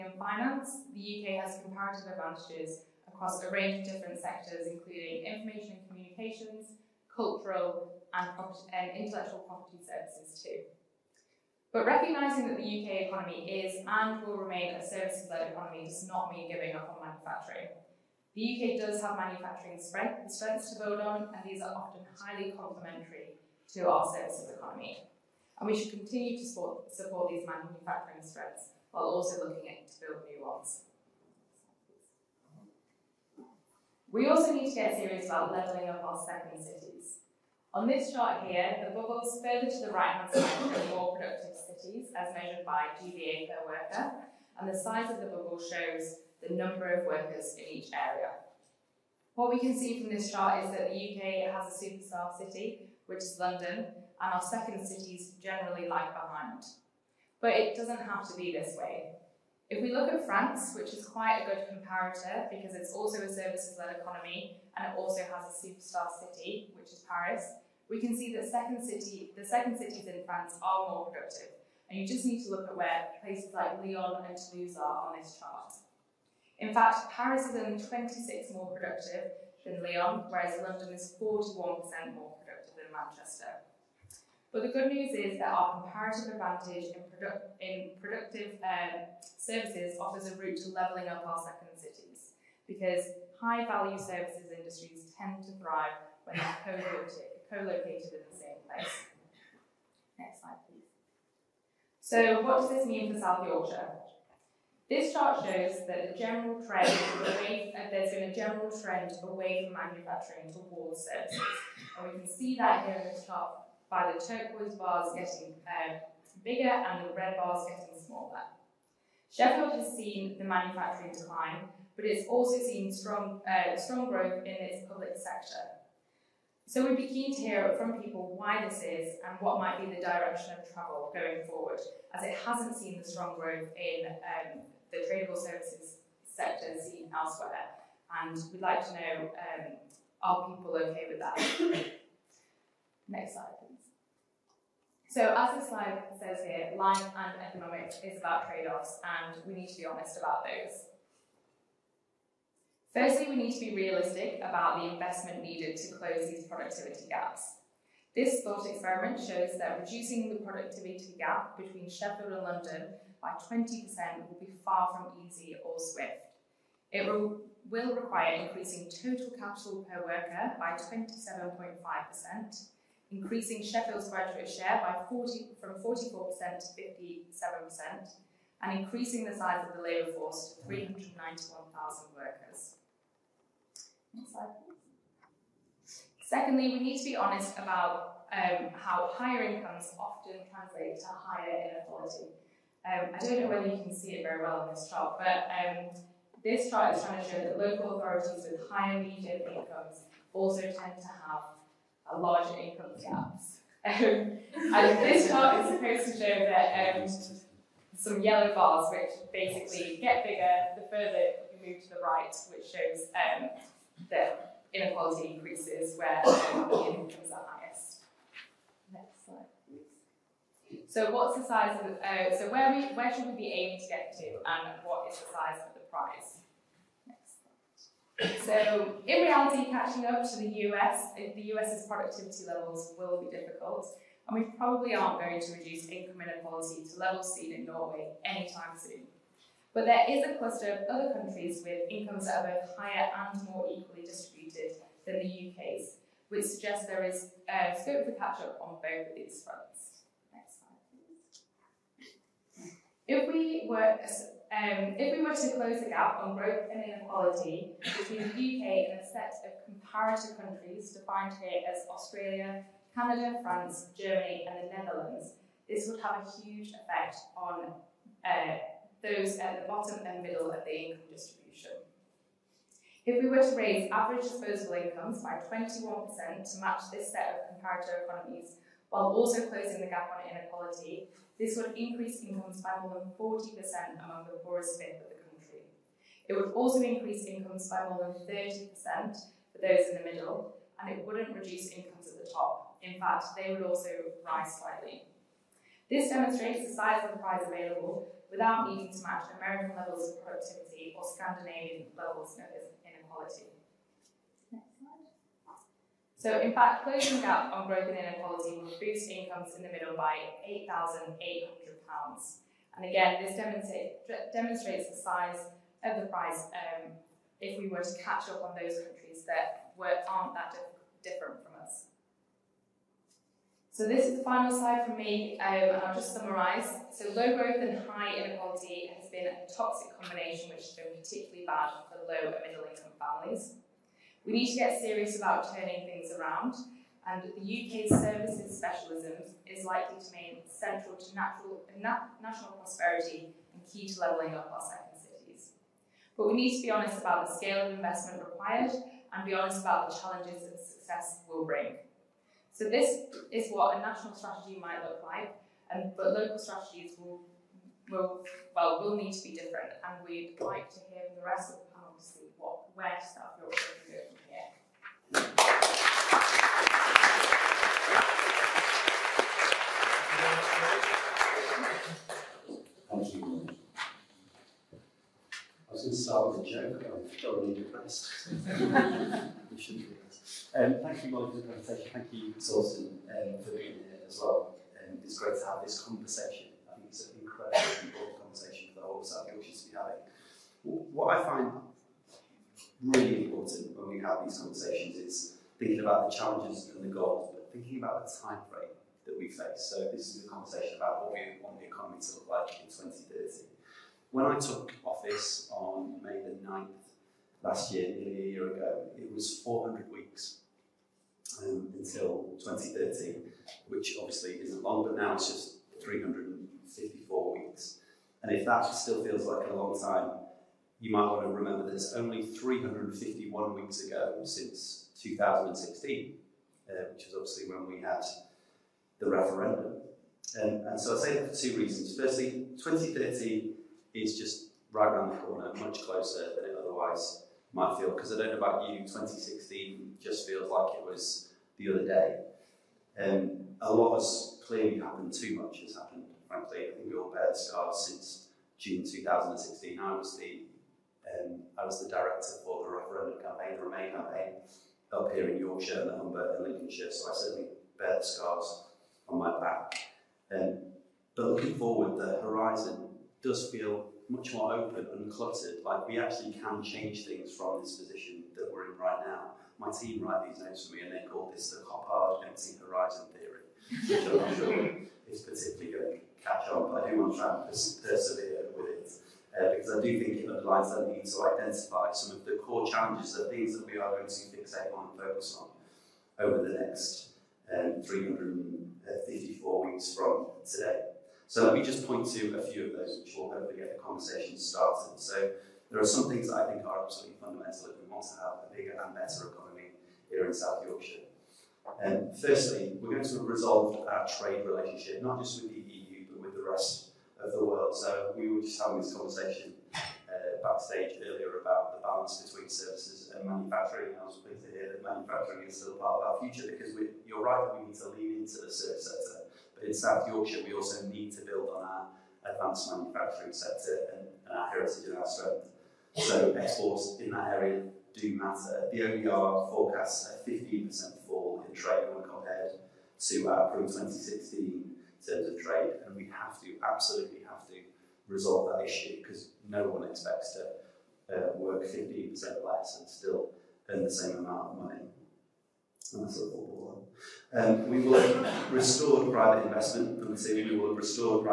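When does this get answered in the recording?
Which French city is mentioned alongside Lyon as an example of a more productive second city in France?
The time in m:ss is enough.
1:14.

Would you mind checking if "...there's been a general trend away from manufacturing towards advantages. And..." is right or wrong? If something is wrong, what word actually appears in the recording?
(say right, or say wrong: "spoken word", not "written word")
wrong: "services", not "advantages".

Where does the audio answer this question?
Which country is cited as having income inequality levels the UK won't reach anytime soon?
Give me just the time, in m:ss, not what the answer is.
3:57.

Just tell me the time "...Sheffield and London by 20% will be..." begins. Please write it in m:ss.
2:41.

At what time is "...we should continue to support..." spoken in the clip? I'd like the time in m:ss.
0:25.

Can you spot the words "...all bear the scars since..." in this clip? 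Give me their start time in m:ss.
7:26.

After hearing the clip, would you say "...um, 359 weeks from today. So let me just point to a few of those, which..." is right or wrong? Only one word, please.
wrong.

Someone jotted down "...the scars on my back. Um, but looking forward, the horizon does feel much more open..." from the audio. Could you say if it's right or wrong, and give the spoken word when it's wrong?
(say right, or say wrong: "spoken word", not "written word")
right.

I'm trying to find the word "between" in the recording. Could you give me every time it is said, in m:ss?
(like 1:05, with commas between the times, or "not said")
2:41, 4:17, 8:32.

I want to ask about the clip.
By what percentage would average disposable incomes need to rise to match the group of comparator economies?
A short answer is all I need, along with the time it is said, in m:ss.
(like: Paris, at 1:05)
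21%, at 4:35.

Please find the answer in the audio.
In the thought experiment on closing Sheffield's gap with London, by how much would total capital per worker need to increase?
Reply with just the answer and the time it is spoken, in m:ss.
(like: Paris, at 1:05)
27.5%, at 2:50.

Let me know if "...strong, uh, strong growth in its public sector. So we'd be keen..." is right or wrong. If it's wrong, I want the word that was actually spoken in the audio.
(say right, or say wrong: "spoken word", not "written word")
right.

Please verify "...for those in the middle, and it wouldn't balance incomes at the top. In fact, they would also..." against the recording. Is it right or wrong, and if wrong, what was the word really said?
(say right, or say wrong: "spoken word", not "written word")
wrong: "reduce", not "balance".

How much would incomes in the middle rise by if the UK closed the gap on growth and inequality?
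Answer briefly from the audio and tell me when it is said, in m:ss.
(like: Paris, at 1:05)
£8,800, at 5:10.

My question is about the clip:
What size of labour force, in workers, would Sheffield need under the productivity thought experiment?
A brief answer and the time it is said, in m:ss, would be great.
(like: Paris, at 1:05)
391,000, at 3:00.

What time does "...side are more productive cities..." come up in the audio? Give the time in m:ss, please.
0:40.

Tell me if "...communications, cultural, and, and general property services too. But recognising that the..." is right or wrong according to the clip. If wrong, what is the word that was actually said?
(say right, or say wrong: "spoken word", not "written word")
wrong: "intellectual", not "general".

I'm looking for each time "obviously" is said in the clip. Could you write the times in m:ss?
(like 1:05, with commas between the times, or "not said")
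6:53, 7:07.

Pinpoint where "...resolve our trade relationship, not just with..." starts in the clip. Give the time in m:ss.
8:23.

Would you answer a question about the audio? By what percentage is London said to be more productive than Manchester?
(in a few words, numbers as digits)
41%.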